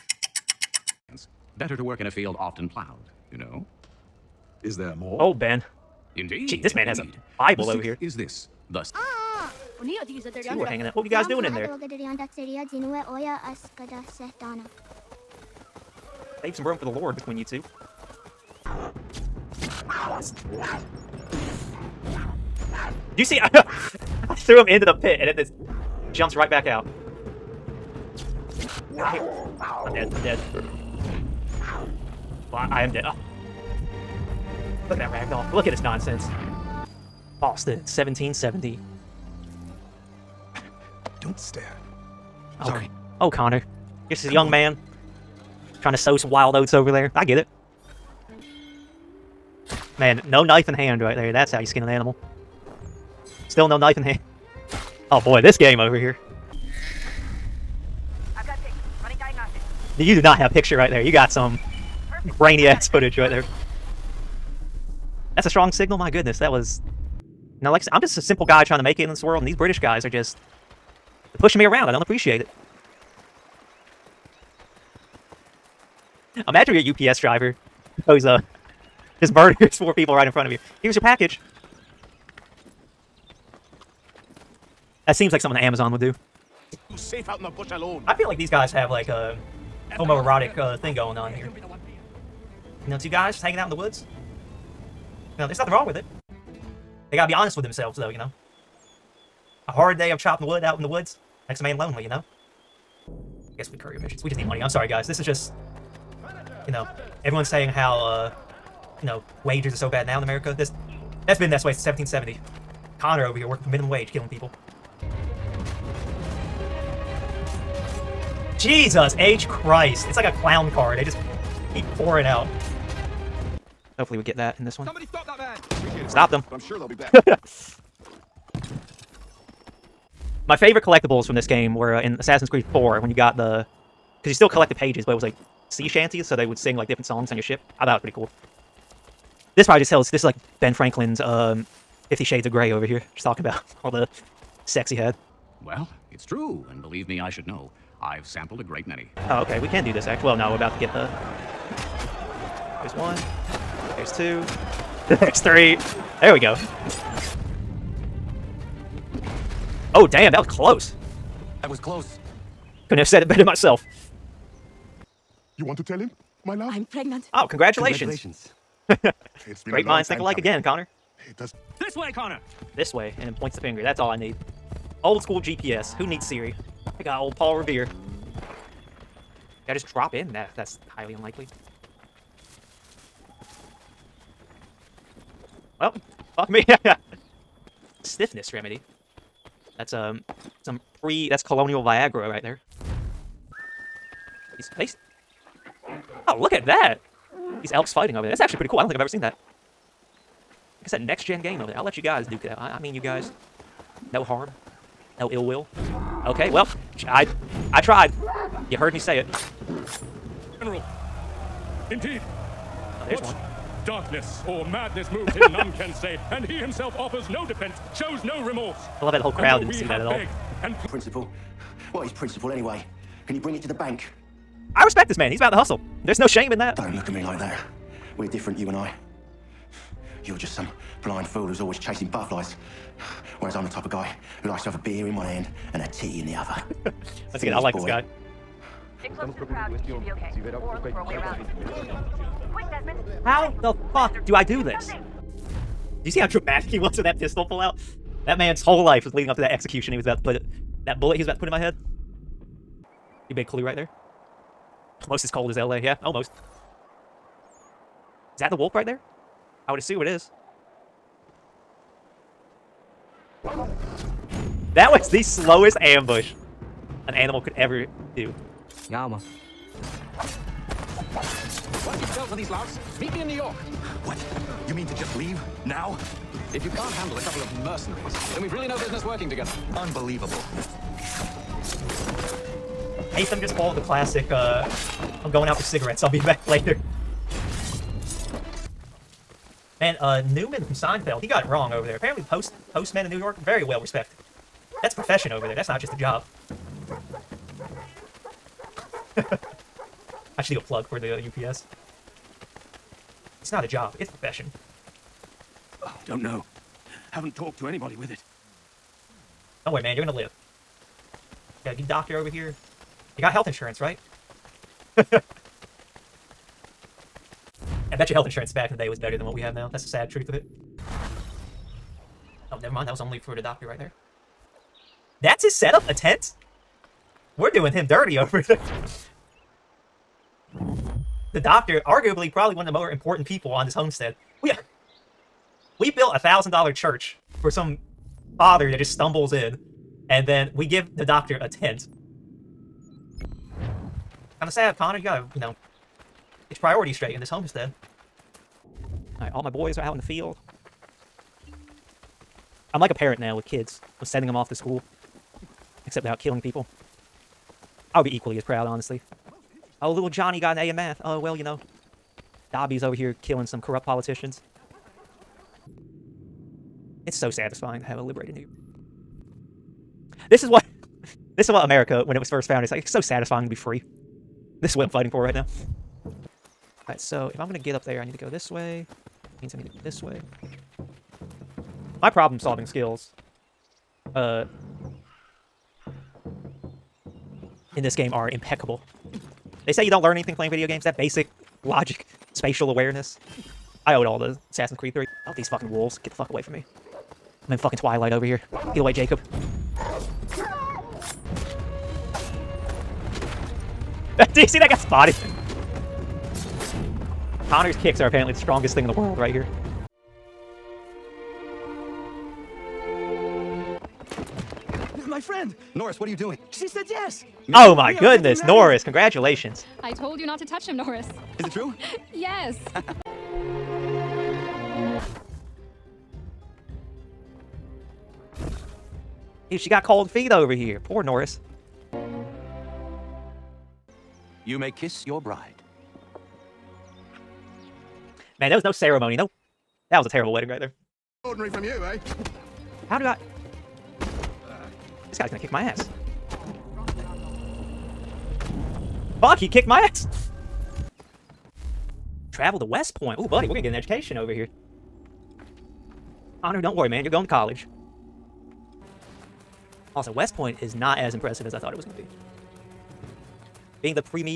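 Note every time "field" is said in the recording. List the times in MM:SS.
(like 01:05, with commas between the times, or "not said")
00:02, 05:50.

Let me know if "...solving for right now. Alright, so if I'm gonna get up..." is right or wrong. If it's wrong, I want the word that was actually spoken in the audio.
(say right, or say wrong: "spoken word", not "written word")
wrong: "fighting", not "solving".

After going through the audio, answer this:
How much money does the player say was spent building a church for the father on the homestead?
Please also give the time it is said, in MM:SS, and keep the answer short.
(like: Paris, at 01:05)
$1,000, at 05:36.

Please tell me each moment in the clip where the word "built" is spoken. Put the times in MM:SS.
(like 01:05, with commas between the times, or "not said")
05:35.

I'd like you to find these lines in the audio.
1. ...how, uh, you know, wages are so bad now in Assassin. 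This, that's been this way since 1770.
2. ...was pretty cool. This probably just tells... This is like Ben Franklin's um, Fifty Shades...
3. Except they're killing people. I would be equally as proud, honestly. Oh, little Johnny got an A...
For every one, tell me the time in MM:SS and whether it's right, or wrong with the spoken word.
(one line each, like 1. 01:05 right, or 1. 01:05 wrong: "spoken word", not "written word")
1. 01:47 wrong: "America", not "Assassin"
2. 02:17 right
3. 05:55 right.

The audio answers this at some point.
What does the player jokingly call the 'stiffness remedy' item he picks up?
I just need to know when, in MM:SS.
03:11.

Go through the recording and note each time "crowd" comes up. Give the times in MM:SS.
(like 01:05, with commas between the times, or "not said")
03:39, 03:59.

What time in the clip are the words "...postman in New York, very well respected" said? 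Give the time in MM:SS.
04:52.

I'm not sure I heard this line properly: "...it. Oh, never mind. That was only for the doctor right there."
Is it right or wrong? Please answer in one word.
right.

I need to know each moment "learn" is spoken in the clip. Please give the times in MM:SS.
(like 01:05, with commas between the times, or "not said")
06:30.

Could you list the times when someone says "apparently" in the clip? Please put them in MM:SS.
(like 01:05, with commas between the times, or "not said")
04:51, 06:48.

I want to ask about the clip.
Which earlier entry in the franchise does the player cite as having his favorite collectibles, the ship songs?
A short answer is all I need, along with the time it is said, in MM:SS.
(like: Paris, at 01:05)
Assassin's Creed 4, at 02:12.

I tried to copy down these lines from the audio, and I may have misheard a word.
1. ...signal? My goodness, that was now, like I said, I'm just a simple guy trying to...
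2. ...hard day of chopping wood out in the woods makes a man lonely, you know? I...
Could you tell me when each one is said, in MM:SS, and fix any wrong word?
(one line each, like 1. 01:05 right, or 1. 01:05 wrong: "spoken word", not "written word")
1. 01:05 right
2. 01:39 right.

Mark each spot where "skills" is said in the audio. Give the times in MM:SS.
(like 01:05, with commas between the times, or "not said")
06:22.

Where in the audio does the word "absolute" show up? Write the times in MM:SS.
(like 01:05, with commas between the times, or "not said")
not said.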